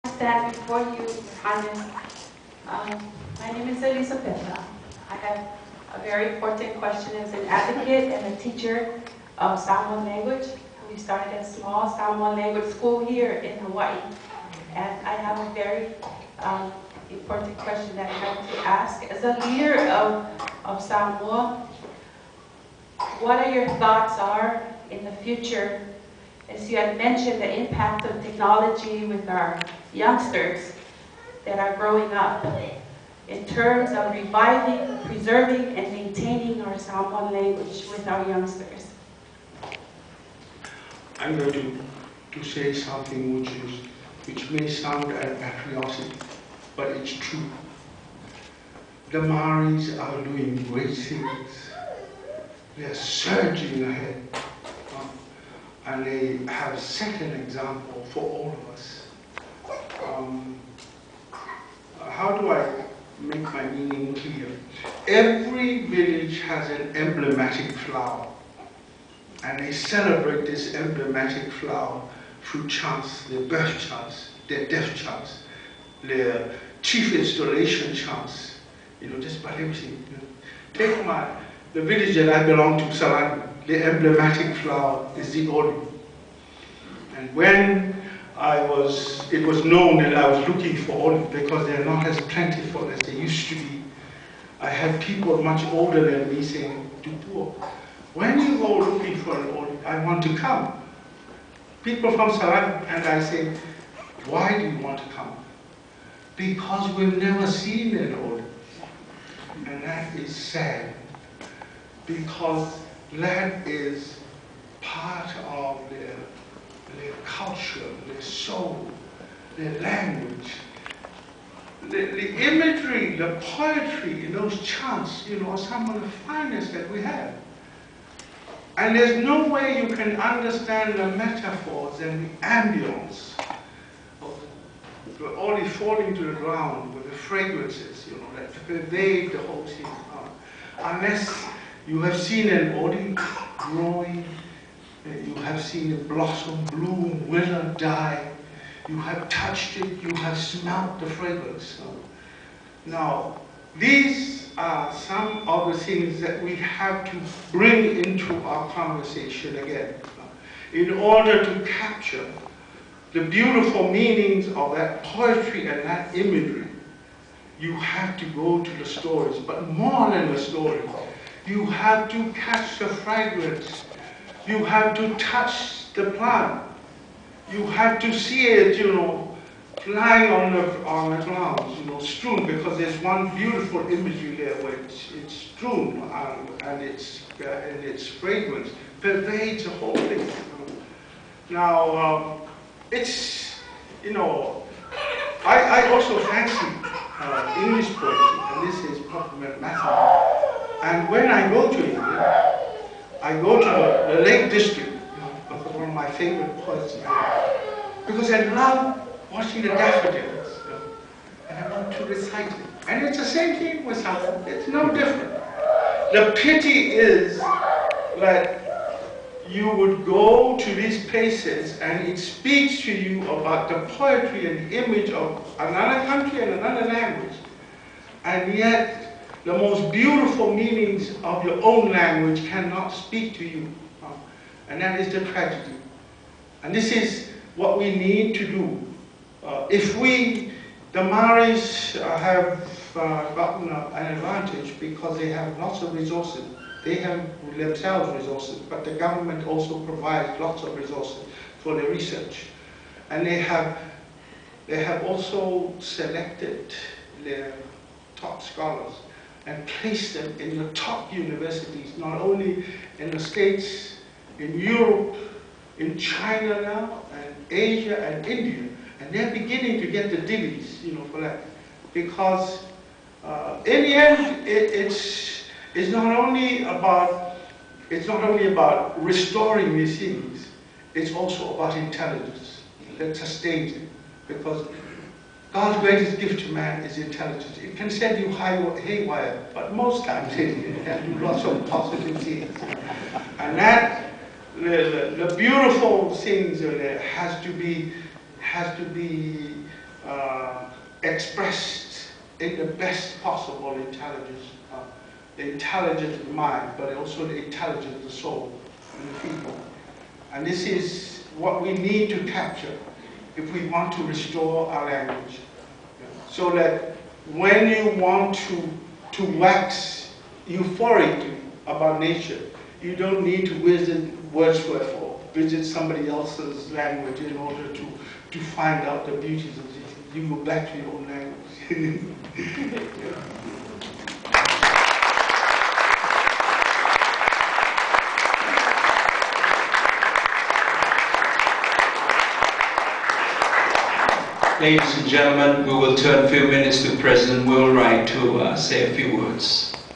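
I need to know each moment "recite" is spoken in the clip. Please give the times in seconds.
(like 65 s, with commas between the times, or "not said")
212 s.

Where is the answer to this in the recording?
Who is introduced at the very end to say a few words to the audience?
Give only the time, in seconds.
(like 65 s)
346 s.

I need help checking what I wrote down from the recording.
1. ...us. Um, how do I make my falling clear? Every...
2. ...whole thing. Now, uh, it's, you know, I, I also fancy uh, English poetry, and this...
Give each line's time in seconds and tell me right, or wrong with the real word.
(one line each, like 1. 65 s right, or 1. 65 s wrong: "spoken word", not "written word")
1. 58 s wrong: "meaning", not "falling"
2. 189 s right.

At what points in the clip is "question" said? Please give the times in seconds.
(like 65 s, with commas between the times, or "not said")
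6 s, 17 s.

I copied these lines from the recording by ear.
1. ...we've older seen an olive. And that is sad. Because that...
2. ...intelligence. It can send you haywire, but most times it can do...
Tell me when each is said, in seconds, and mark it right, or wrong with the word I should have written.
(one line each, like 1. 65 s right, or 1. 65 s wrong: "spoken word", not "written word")
1. 106 s wrong: "never", not "older"
2. 286 s right.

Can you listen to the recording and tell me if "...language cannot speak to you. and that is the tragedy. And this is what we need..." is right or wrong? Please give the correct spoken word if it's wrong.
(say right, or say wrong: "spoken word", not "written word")
right.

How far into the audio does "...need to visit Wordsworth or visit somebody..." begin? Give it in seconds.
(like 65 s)
323 s.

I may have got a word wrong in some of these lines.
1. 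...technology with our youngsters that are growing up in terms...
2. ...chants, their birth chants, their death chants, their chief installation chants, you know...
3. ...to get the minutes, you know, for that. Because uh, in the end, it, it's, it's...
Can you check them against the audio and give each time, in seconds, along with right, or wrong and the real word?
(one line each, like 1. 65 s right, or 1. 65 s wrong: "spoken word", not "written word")
1. 28 s right
2. 72 s right
3. 269 s wrong: "divvies", not "minutes".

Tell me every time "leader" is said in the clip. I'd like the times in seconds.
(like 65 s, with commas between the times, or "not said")
19 s.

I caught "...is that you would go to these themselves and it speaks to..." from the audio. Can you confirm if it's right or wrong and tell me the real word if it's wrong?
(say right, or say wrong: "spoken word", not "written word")
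wrong: "places", not "themselves".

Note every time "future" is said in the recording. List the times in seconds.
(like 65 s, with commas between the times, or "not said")
25 s.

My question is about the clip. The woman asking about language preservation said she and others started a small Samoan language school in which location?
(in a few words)
Hawaii.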